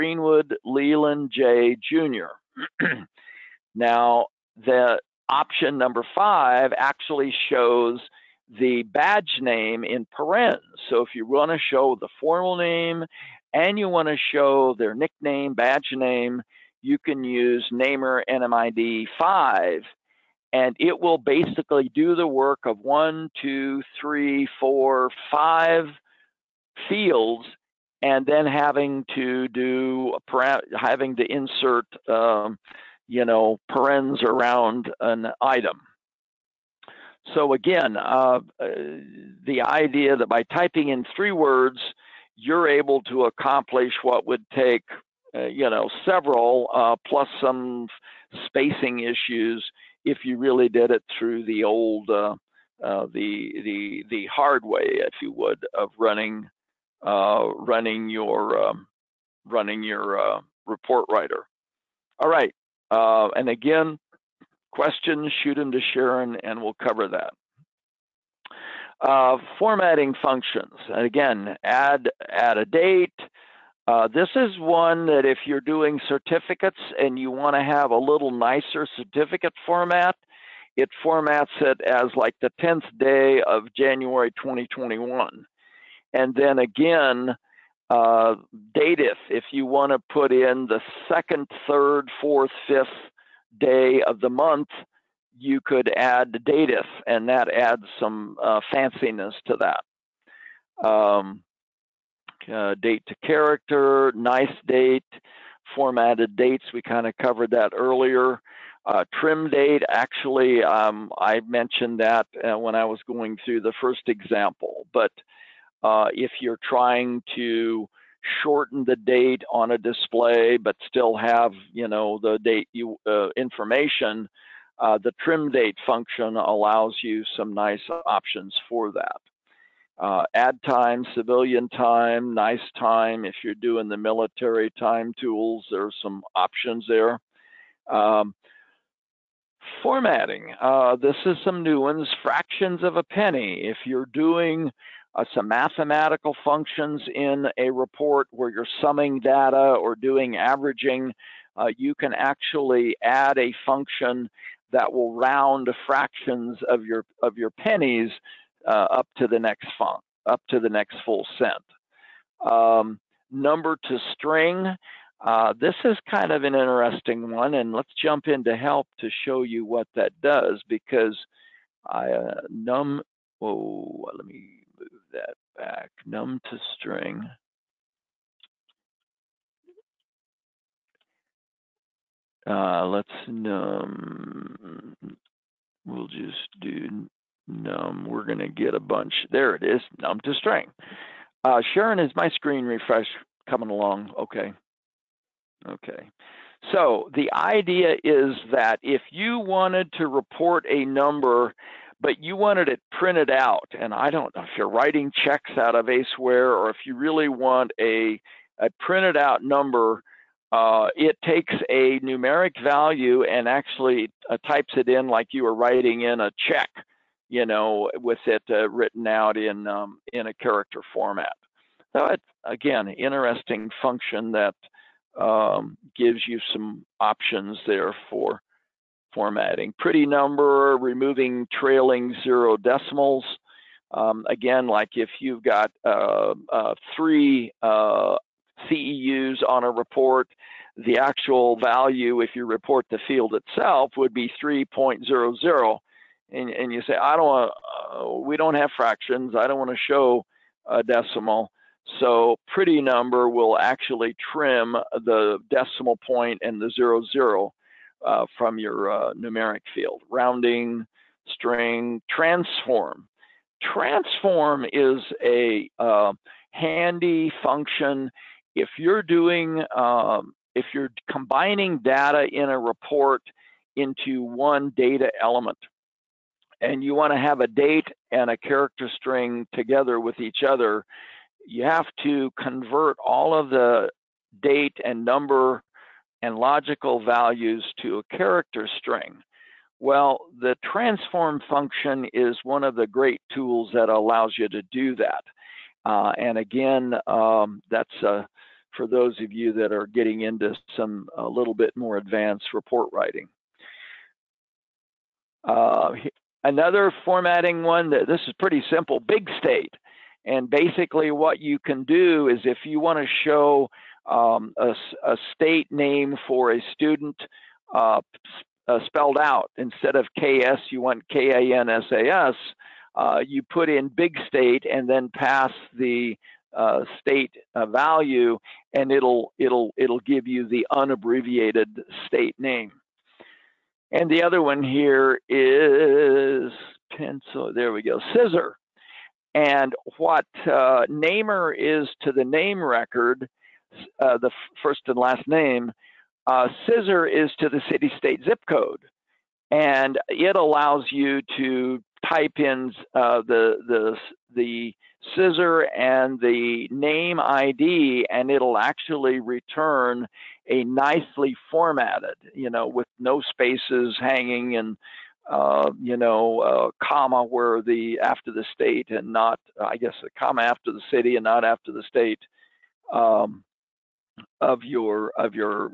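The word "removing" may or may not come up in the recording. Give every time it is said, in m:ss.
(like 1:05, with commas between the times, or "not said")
3:50.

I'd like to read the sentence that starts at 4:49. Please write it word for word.
Well, the transform function is one of the great tools that allows you to do that.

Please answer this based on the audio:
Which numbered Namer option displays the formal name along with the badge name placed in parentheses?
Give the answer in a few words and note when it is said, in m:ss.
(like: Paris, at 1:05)
5, at 0:05.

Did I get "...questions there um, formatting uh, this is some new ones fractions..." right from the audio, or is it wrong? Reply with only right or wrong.
wrong.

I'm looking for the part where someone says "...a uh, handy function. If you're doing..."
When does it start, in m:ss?
4:25.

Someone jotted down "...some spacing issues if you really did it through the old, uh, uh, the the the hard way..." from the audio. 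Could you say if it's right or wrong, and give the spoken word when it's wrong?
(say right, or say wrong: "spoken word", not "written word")
right.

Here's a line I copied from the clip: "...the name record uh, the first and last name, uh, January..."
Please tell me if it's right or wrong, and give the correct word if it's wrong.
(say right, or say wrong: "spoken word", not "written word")
wrong: "Scissor", not "January".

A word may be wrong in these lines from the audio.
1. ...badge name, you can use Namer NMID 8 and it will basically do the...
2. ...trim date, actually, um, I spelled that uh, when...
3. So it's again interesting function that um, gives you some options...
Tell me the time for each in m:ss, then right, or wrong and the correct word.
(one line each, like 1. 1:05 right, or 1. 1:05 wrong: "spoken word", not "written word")
1. 0:15 wrong: "5", not "8"
2. 1:49 wrong: "mentioned", not "spelled"
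3. 3:41 right.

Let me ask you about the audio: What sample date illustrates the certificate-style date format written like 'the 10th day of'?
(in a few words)
January 2021.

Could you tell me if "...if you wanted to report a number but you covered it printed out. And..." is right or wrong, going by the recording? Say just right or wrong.
wrong.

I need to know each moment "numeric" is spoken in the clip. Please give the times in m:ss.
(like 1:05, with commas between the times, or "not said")
3:31, 4:19.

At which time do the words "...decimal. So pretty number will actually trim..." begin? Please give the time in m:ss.
4:10.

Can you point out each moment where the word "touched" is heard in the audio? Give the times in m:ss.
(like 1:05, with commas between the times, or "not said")
not said.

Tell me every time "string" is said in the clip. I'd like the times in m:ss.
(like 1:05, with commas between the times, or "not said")
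2:44, 2:56, 3:10, 4:21, 4:38, 4:48.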